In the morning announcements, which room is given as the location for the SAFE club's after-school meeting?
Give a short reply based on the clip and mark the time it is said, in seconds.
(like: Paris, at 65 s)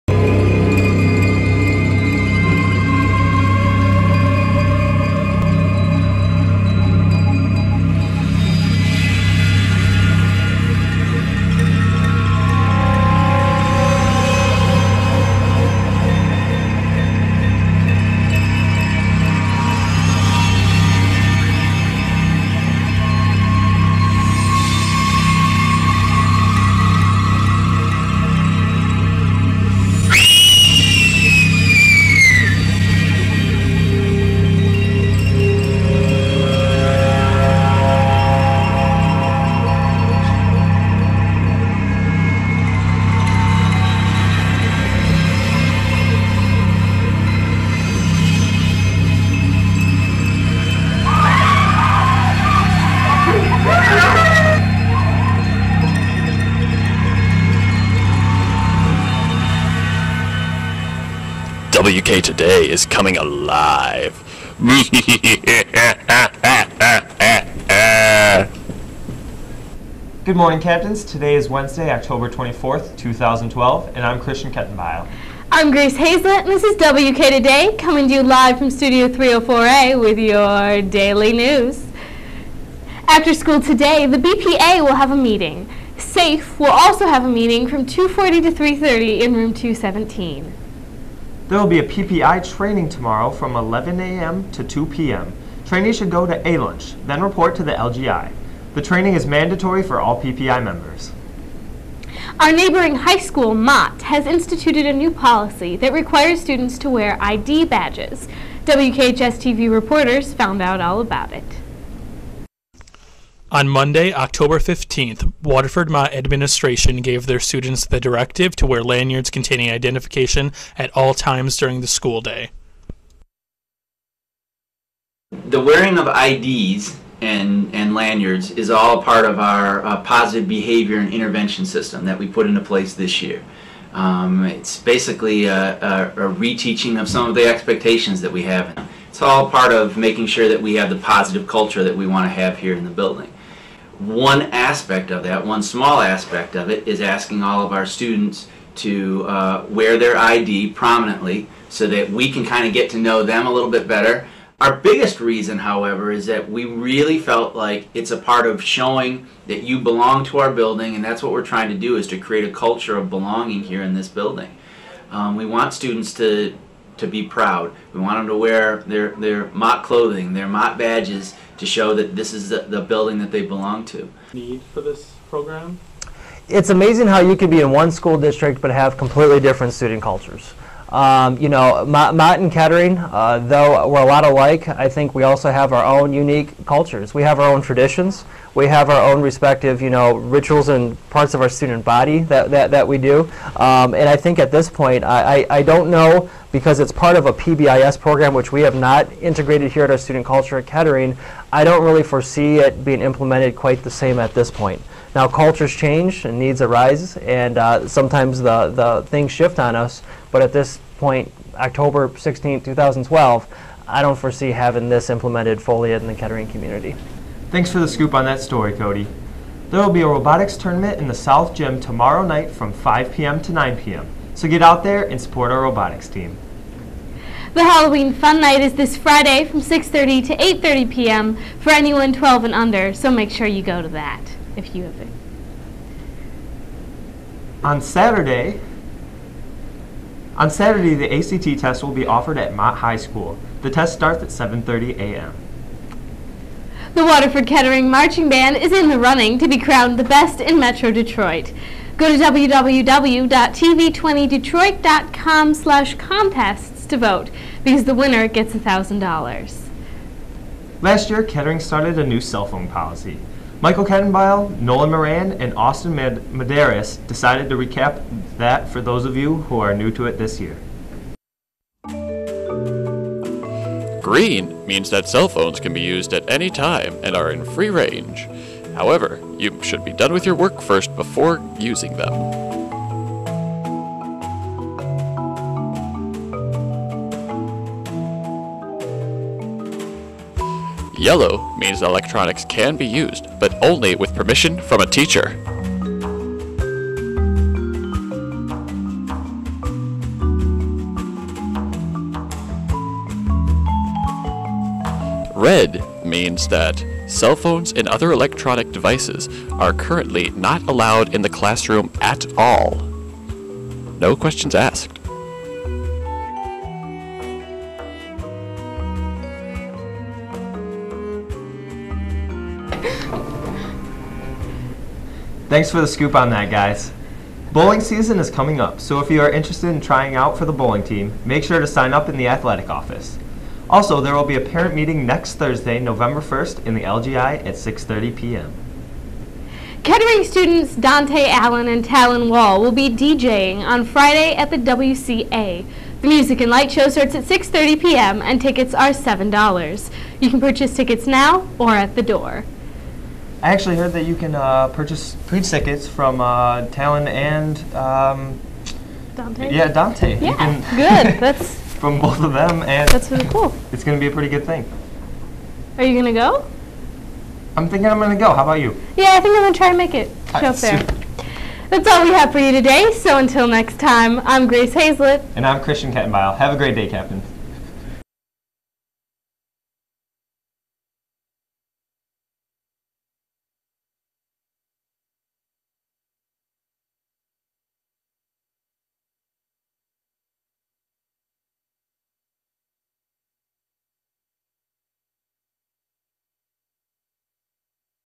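Room 217, at 89 s.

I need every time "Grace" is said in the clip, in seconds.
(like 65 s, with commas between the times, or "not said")
75 s, 374 s.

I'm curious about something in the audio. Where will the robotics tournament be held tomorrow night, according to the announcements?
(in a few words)
South Gym.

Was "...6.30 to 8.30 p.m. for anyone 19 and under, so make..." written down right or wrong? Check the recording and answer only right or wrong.
wrong.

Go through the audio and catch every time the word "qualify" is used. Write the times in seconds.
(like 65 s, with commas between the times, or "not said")
not said.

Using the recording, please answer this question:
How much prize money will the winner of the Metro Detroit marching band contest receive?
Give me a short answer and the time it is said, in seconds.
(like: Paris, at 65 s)
$1,000, at 258 s.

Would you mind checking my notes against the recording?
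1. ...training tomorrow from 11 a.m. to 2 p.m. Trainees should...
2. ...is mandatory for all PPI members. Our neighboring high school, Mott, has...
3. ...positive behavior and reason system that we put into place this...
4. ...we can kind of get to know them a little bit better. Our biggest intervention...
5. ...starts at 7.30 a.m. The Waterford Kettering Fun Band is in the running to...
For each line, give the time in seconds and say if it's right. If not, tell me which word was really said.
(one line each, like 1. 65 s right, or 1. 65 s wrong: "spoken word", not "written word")
1. 92 s right
2. 99 s right
3. 130 s wrong: "intervention", not "reason"
4. 152 s wrong: "reason", not "intervention"
5. 243 s wrong: "Marching", not "Fun".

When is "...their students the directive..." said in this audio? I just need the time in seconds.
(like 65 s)
117 s.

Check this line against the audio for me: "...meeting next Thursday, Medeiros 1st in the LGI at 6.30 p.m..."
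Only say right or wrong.
wrong.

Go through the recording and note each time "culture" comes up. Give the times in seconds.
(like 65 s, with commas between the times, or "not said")
141 s, 162 s, 180 s, 186 s, 200 s, 205 s.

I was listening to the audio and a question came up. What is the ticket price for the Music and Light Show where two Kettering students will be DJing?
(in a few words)
$7.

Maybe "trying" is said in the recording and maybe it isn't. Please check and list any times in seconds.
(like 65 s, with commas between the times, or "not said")
161 s, 329 s.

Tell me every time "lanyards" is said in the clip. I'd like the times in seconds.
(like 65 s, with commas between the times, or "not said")
118 s, 127 s.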